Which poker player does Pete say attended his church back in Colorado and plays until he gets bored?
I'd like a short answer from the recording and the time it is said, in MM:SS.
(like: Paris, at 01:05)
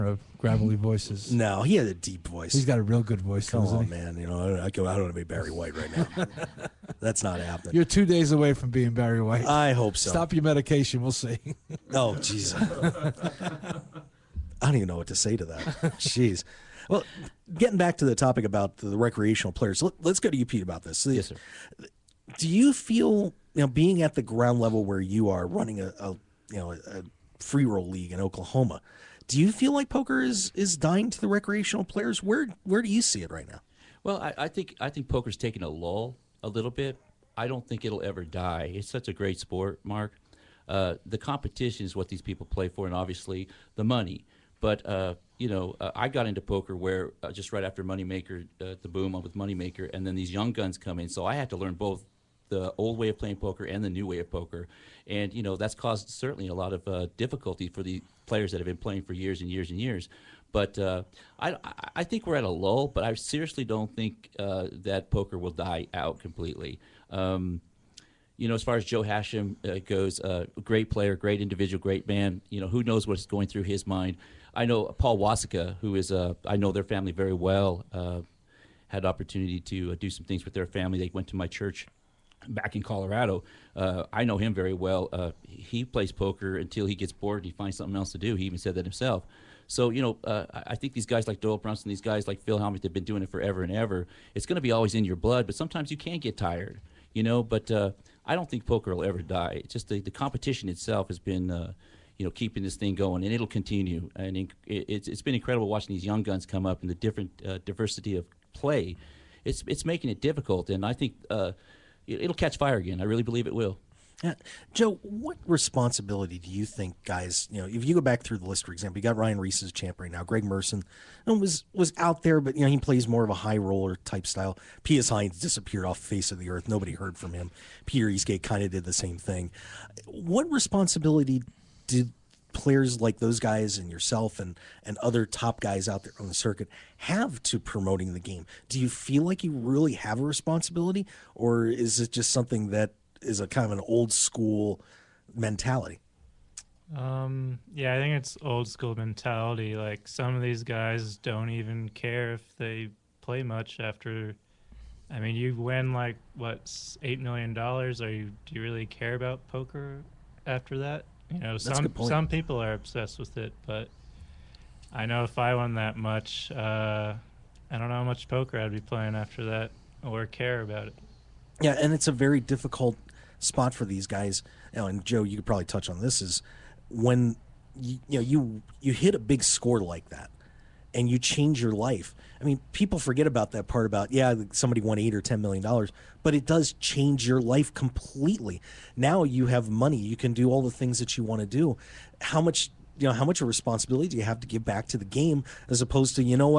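Paul Wasicka, at 01:14.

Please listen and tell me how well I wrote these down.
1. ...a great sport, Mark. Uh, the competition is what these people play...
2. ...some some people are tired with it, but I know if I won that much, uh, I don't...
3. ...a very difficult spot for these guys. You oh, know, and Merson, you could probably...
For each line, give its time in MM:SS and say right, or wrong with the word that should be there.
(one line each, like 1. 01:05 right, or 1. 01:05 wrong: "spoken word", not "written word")
1. 00:39 right
2. 02:41 wrong: "obsessed", not "tired"
3. 02:52 wrong: "Joe", not "Merson".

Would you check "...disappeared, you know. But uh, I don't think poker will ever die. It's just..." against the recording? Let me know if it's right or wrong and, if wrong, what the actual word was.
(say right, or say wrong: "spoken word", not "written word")
wrong: "tired", not "disappeared".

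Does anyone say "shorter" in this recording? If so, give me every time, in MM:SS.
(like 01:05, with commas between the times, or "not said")
not said.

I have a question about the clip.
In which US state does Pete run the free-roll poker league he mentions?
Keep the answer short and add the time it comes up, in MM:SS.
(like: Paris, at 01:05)
Oklahoma, at 00:28.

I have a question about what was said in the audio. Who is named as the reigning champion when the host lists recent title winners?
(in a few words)
Ryan Riess.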